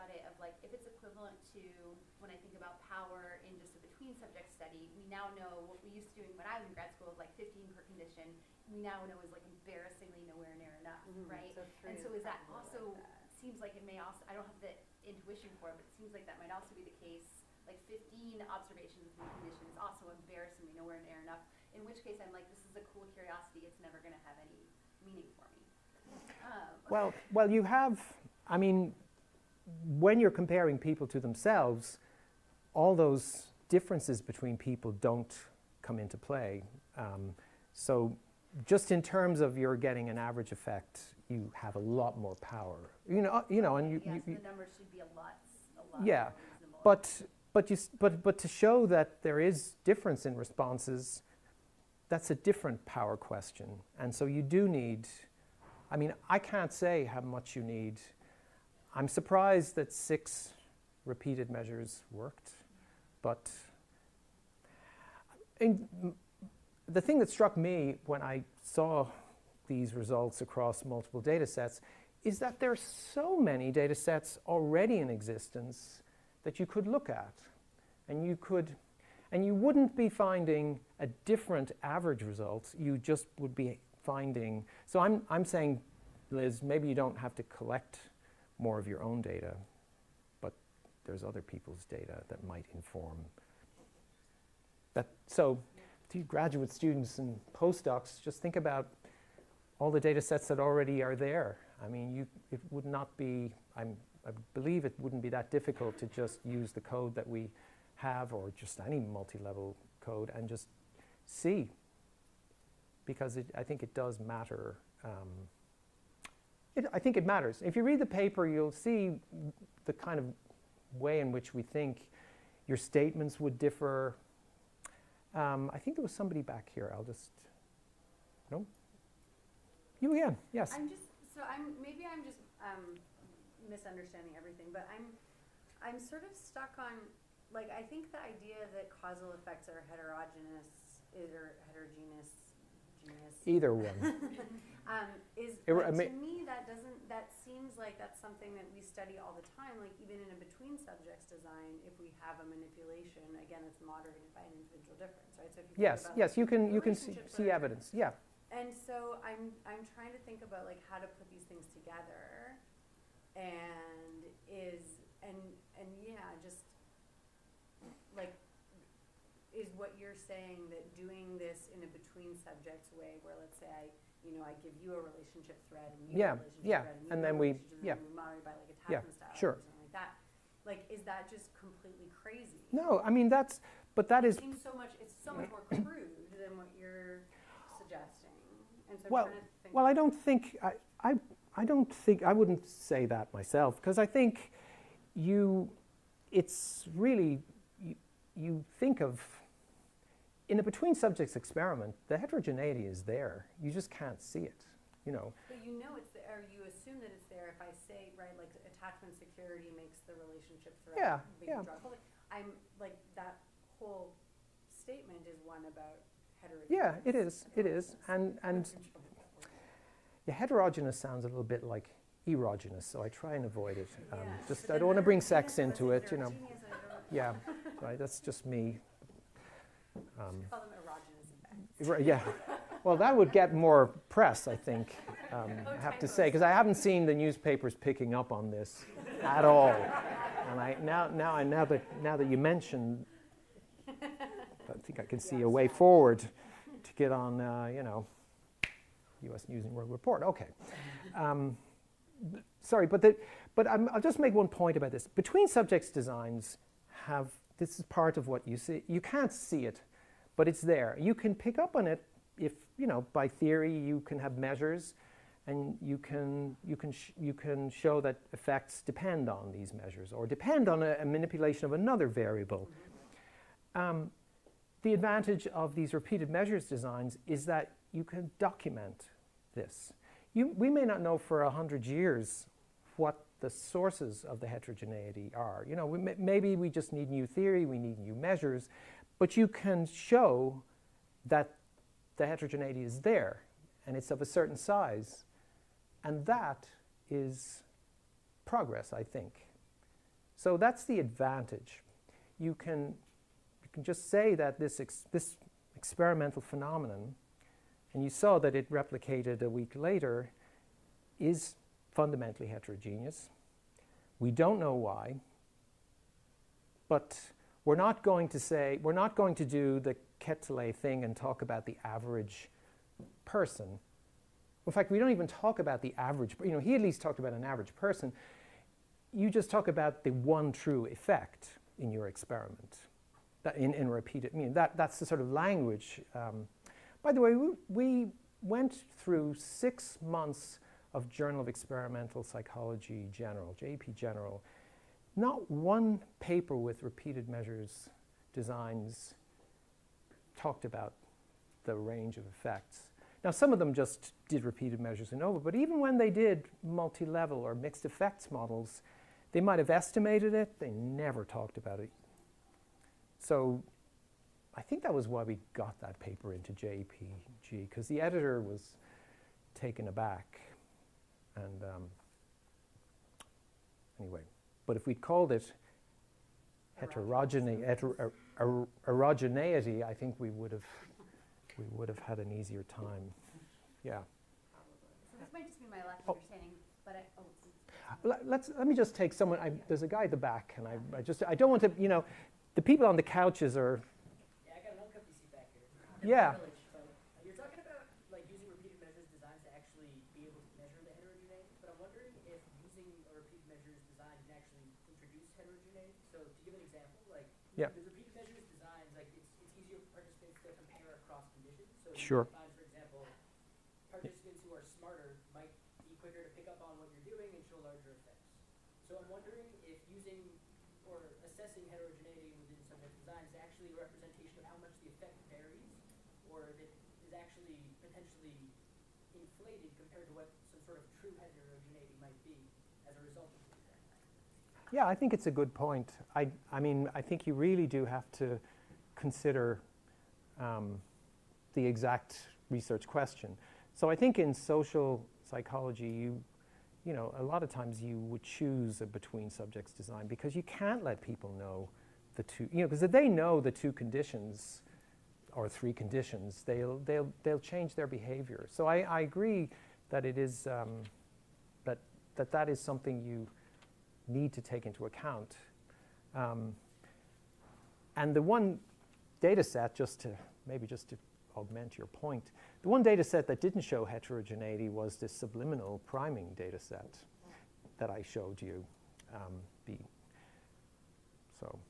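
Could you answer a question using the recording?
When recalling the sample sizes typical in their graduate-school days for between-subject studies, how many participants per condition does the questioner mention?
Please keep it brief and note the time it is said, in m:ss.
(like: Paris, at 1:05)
15, at 0:07.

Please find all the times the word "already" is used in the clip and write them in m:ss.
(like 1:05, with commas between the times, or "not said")
1:14, 1:40.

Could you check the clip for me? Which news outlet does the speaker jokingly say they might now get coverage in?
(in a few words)
U.S. News and World Report.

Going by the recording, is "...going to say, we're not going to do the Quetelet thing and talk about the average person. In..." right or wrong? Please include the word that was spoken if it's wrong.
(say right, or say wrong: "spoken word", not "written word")
right.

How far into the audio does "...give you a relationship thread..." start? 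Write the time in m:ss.
2:54.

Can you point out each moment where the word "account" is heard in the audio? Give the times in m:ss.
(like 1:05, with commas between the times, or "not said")
7:44.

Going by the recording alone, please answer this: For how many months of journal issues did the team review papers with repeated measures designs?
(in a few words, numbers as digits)
6.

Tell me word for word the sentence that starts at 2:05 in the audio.
Um, I think there was somebody back here.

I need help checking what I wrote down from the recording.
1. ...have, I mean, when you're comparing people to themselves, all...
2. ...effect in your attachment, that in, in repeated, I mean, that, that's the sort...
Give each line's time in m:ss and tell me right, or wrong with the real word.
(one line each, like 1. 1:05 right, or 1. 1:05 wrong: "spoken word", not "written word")
1. 0:27 right
2. 5:30 wrong: "experiment", not "attachment".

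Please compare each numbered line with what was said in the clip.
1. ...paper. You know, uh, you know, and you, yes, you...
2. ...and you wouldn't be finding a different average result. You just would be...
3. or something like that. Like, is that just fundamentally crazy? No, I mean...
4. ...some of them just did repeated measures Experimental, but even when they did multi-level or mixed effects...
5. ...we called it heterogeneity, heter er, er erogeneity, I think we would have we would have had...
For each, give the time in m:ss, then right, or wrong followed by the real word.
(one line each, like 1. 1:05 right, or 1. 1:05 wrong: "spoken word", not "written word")
1. 0:42 wrong: "power", not "paper"
2. 1:19 right
3. 2:59 wrong: "completely", not "fundamentally"
4. 5:53 wrong: "ANOVA", not "Experimental"
5. 6:14 right.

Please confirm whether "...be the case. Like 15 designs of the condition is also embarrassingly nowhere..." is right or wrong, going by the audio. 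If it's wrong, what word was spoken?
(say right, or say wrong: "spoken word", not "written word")
wrong: "observations", not "designs".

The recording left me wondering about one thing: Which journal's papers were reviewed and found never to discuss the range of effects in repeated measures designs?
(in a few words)
Journal of Experimental Psychology General.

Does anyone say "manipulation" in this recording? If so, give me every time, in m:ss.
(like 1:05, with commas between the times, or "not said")
2:32, 4:31.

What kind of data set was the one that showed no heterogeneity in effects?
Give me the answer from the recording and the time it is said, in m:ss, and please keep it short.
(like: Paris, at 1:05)
subliminal priming, at 7:55.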